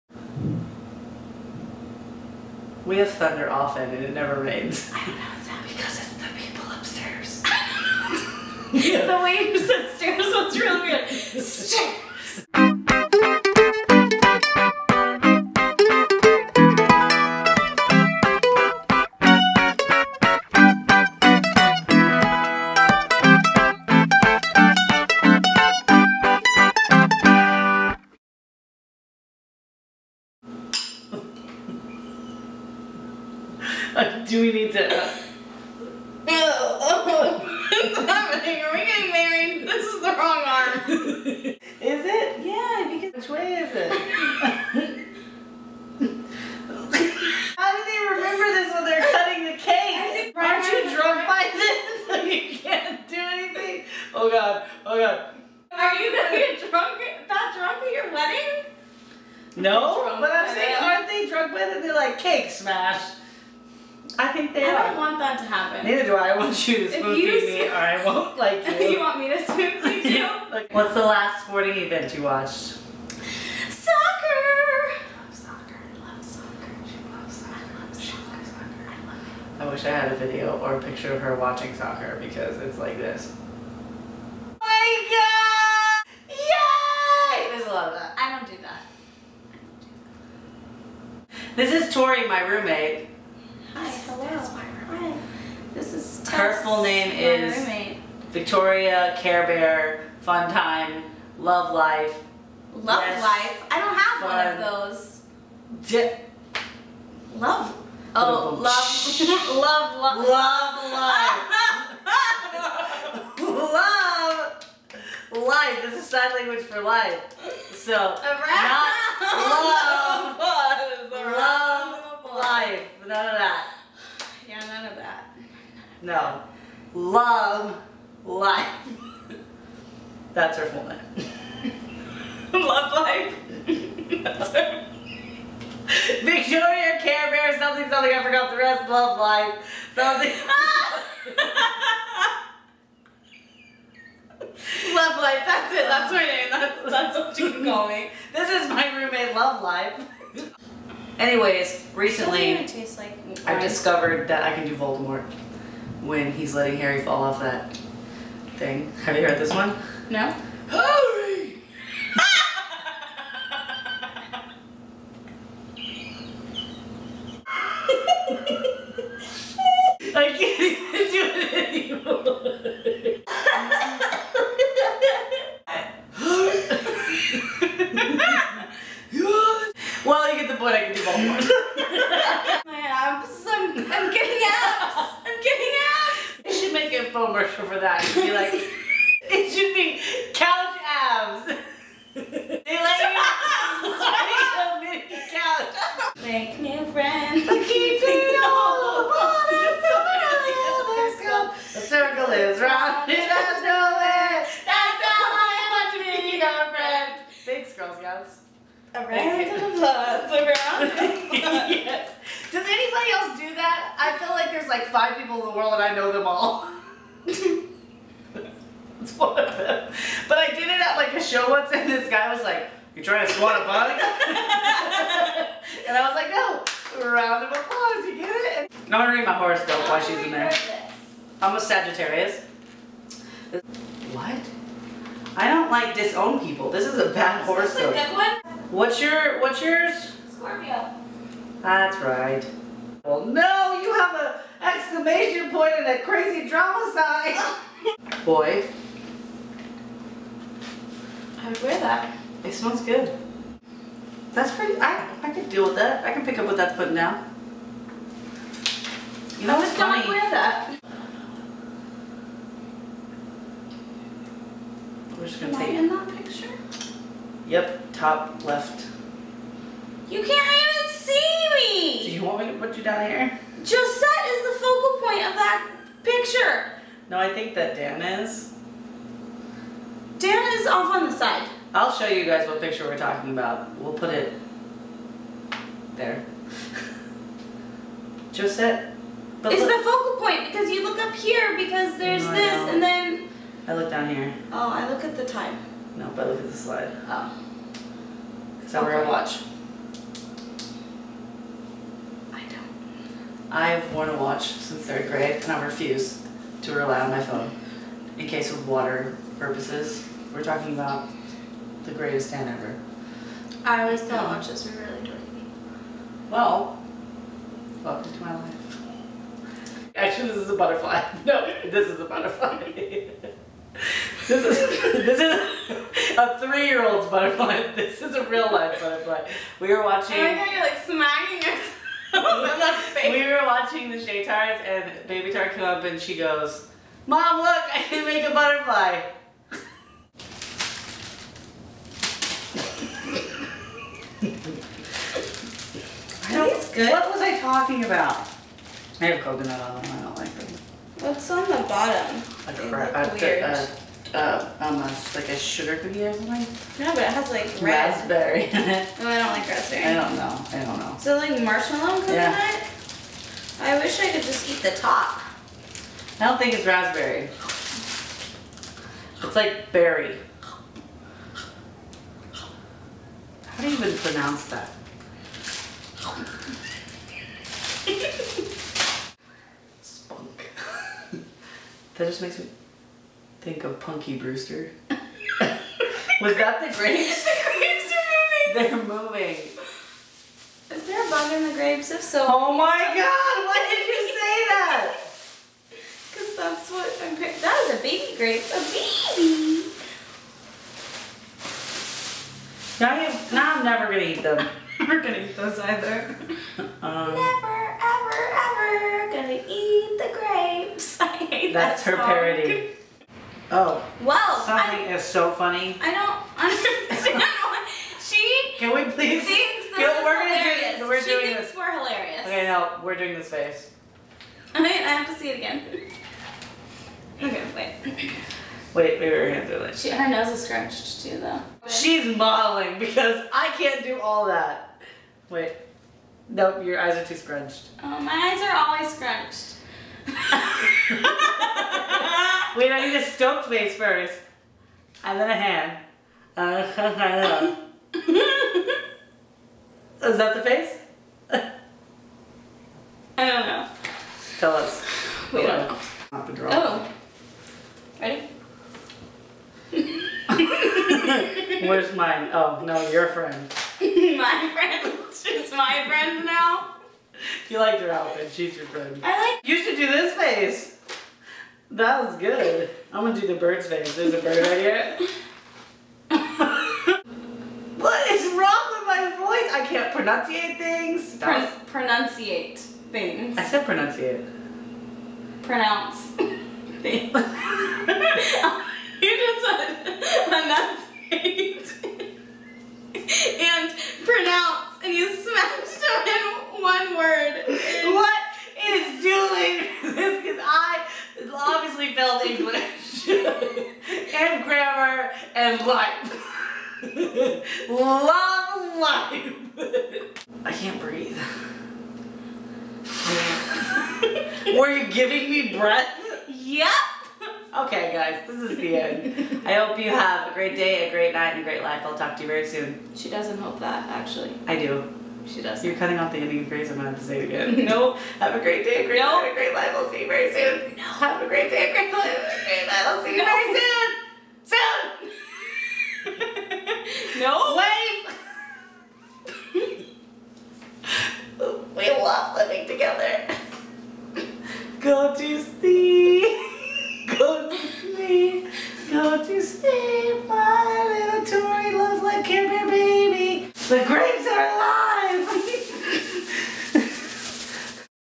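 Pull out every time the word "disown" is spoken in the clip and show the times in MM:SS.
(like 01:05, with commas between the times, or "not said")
03:55.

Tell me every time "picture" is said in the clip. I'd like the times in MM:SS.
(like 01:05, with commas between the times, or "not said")
01:20, 04:26, 04:36, 04:42.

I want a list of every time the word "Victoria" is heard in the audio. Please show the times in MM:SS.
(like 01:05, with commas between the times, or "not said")
01:38, 02:16.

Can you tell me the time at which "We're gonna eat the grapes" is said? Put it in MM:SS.
06:48.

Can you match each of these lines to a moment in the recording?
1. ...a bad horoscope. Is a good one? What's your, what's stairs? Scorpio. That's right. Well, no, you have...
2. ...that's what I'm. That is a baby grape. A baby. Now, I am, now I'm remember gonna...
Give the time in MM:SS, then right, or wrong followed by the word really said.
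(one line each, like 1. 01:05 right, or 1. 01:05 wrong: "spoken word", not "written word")
1. 03:56 wrong: "yours", not "stairs"
2. 06:36 wrong: "never", not "remember".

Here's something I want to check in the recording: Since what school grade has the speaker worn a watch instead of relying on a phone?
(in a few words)
Third grade.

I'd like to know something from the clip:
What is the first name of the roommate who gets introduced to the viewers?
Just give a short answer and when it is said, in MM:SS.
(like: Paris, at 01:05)
Tori, at 01:31.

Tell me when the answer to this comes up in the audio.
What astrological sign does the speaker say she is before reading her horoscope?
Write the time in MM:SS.
03:51.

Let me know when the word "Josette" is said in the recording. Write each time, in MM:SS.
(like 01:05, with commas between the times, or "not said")
04:33, 04:48.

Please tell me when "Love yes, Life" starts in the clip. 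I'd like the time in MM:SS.
01:42.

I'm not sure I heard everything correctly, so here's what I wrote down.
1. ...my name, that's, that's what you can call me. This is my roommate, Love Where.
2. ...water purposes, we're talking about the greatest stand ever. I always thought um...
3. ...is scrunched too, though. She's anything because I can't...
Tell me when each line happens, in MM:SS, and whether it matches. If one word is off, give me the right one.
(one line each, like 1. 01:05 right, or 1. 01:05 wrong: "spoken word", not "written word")
1. 02:26 wrong: "Life", not "Where"
2. 05:08 right
3. 07:10 wrong: "modeling", not "anything".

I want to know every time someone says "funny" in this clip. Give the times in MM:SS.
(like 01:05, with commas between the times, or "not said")
04:19, 06:55.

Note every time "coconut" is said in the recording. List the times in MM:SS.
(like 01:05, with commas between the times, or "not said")
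05:49, 06:02.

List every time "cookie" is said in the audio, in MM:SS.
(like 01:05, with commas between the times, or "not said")
05:55.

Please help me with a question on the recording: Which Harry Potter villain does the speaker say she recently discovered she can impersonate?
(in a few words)
Voldemort.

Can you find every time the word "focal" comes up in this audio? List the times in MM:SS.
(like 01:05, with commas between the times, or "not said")
04:34, 04:49.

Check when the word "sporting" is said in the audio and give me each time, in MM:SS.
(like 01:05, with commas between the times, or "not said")
01:11.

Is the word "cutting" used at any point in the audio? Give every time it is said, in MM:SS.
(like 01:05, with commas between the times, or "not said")
00:49, 08:45.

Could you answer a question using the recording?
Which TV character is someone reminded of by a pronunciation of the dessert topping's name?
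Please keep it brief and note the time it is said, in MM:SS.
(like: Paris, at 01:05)
Punky Brewster, at 06:23.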